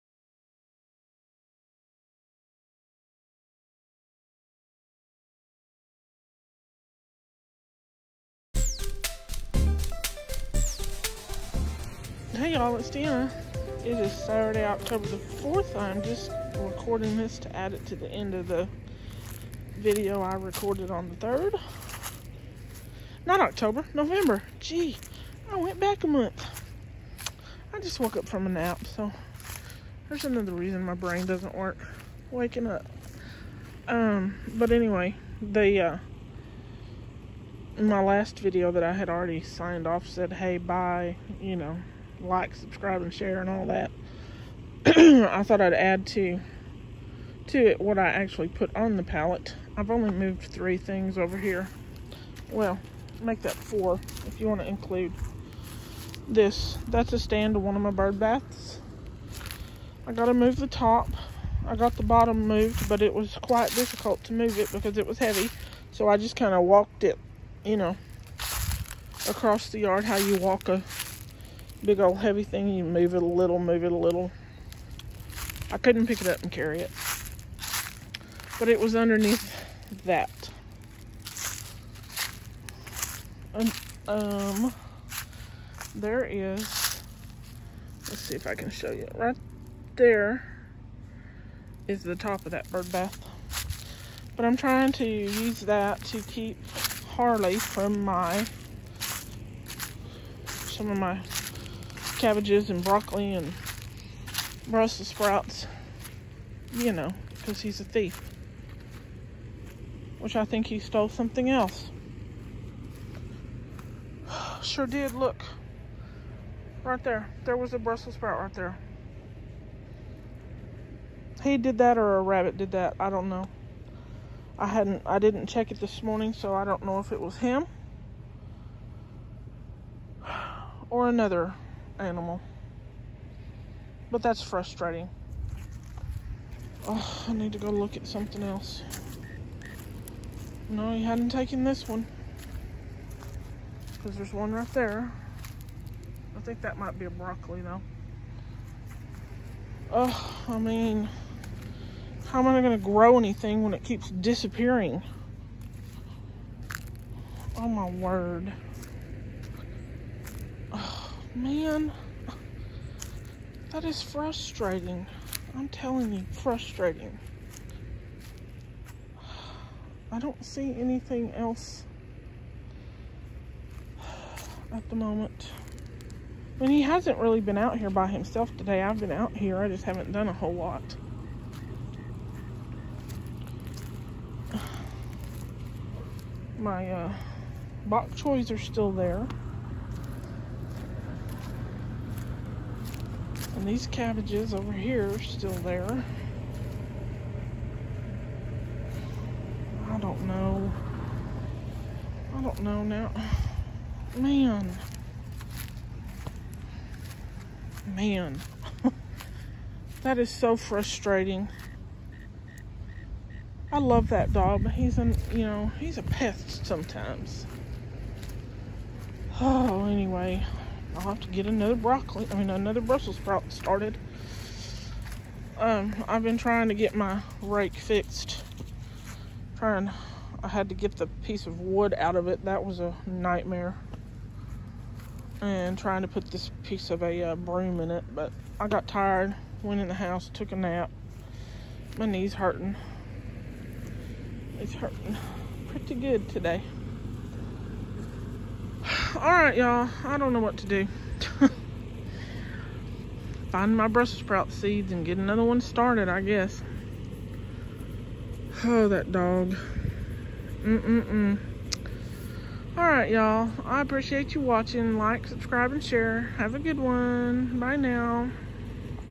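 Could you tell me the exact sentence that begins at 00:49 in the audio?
I've only moved three things over here.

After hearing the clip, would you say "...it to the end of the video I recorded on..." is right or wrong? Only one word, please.
right.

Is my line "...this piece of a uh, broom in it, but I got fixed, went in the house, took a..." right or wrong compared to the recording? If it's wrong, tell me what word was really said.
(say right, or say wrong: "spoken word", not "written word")
wrong: "tired", not "fixed".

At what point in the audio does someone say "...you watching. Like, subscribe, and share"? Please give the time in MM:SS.
04:24.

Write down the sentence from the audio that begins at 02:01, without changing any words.
He did that or a rabbit did that.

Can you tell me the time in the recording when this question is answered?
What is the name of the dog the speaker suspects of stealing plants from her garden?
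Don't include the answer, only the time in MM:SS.
01:37.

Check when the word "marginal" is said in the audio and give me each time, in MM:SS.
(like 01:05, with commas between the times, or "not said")
not said.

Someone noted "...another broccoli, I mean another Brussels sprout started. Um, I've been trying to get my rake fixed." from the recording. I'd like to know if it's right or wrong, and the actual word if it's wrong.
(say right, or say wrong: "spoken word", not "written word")
right.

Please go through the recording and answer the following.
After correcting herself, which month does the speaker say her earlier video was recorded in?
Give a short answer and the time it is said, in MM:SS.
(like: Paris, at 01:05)
November, at 00:23.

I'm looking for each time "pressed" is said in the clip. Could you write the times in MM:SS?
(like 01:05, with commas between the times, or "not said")
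not said.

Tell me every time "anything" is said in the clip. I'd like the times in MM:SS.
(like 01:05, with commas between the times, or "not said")
02:33, 02:50.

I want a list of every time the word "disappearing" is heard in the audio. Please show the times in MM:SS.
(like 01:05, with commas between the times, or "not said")
02:34.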